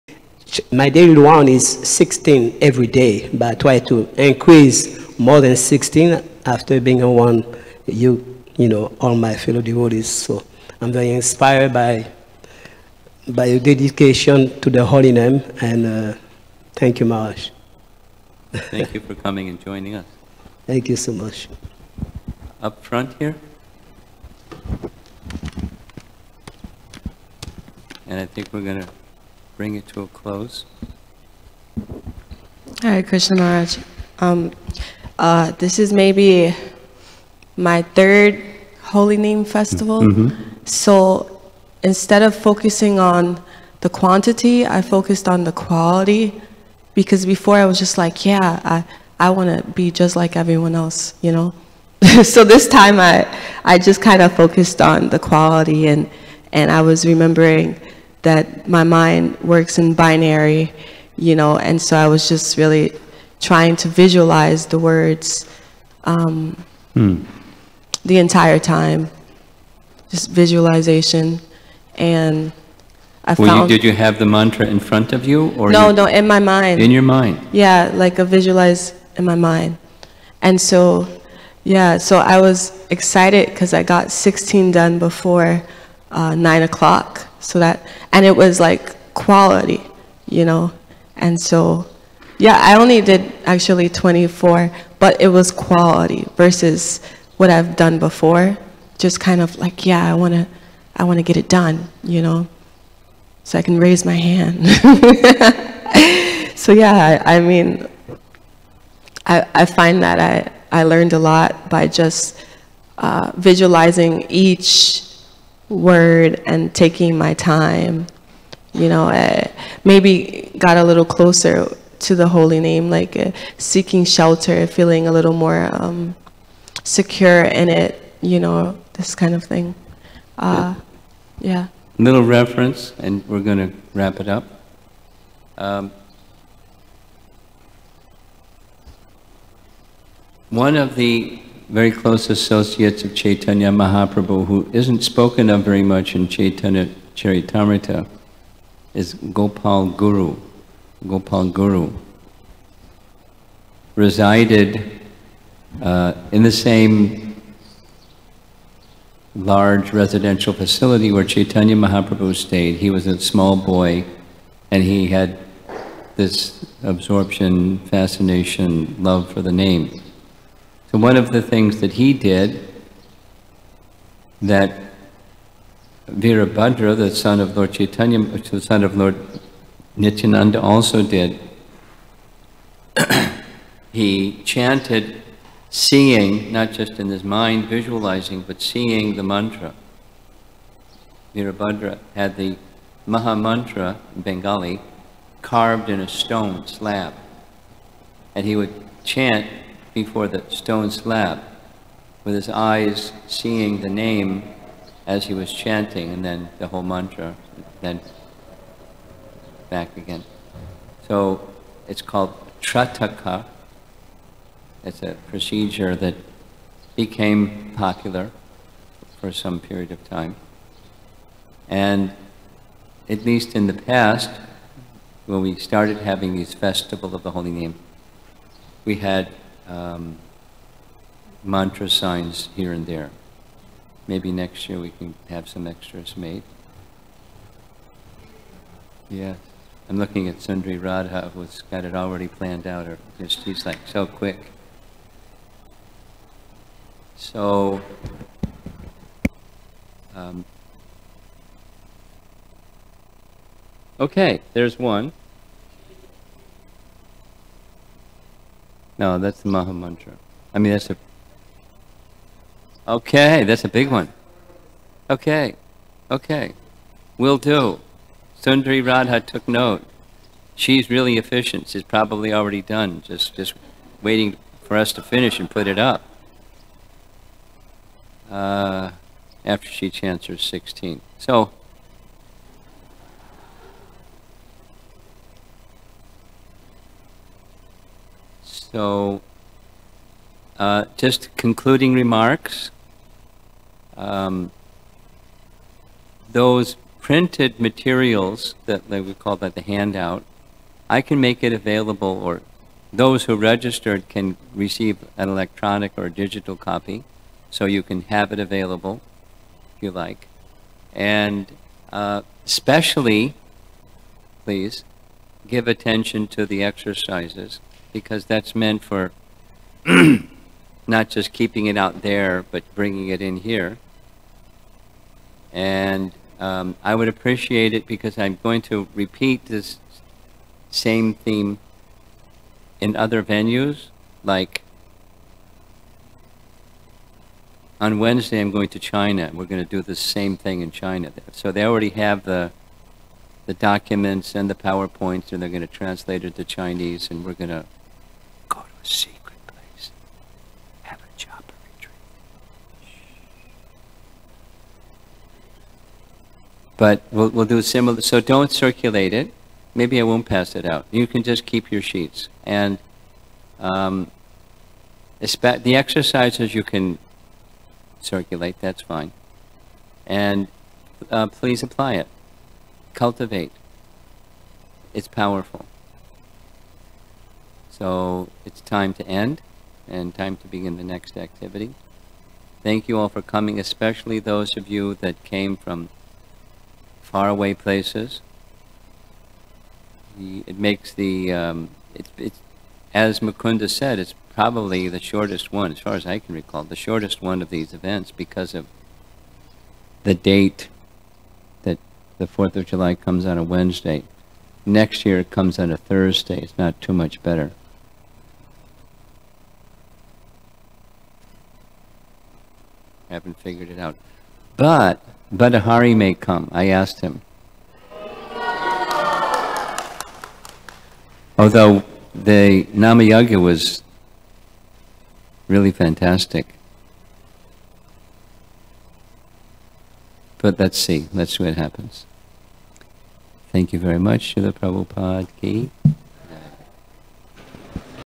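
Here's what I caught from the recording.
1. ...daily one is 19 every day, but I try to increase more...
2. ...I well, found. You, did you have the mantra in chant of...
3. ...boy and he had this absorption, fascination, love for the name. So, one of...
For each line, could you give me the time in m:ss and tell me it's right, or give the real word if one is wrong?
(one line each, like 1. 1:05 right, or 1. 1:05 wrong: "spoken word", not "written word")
1. 0:00 wrong: "16", not "19"
2. 1:13 wrong: "front", not "chant"
3. 2:43 right.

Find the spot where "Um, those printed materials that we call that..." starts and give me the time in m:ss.
4:53.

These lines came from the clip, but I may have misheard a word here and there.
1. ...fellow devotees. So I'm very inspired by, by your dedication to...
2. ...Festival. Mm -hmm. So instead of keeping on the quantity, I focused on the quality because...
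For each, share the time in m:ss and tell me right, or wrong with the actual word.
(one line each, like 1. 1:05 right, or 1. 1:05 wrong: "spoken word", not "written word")
1. 0:09 right
2. 0:39 wrong: "focusing", not "keeping".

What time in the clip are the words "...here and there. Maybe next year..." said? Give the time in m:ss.
3:52.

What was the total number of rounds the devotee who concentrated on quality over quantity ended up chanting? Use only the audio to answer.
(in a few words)
24.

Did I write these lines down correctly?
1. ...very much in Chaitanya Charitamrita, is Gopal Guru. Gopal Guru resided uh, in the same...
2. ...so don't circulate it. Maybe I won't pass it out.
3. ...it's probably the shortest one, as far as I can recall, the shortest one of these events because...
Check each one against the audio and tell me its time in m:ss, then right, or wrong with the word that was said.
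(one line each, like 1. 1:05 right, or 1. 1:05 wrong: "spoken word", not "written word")
1. 2:25 right
2. 5:58 right
3. 6:33 right.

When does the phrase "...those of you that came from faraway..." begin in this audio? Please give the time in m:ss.
6:24.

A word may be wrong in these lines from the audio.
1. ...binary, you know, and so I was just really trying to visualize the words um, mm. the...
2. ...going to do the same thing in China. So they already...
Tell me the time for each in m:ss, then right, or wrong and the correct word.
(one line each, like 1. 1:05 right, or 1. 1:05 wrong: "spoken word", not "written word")
1. 0:59 right
2. 5:39 right.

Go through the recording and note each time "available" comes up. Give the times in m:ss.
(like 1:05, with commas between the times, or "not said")
5:01, 5:08.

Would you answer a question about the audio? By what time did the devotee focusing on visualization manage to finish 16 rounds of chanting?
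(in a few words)
9 o'clock.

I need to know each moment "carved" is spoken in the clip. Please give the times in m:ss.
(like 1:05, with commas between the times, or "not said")
3:15.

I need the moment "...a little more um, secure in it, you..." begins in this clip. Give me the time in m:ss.
2:05.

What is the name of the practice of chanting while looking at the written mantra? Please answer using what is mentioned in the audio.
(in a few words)
Trataka.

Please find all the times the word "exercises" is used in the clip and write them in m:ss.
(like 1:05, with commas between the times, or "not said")
5:16, 6:05.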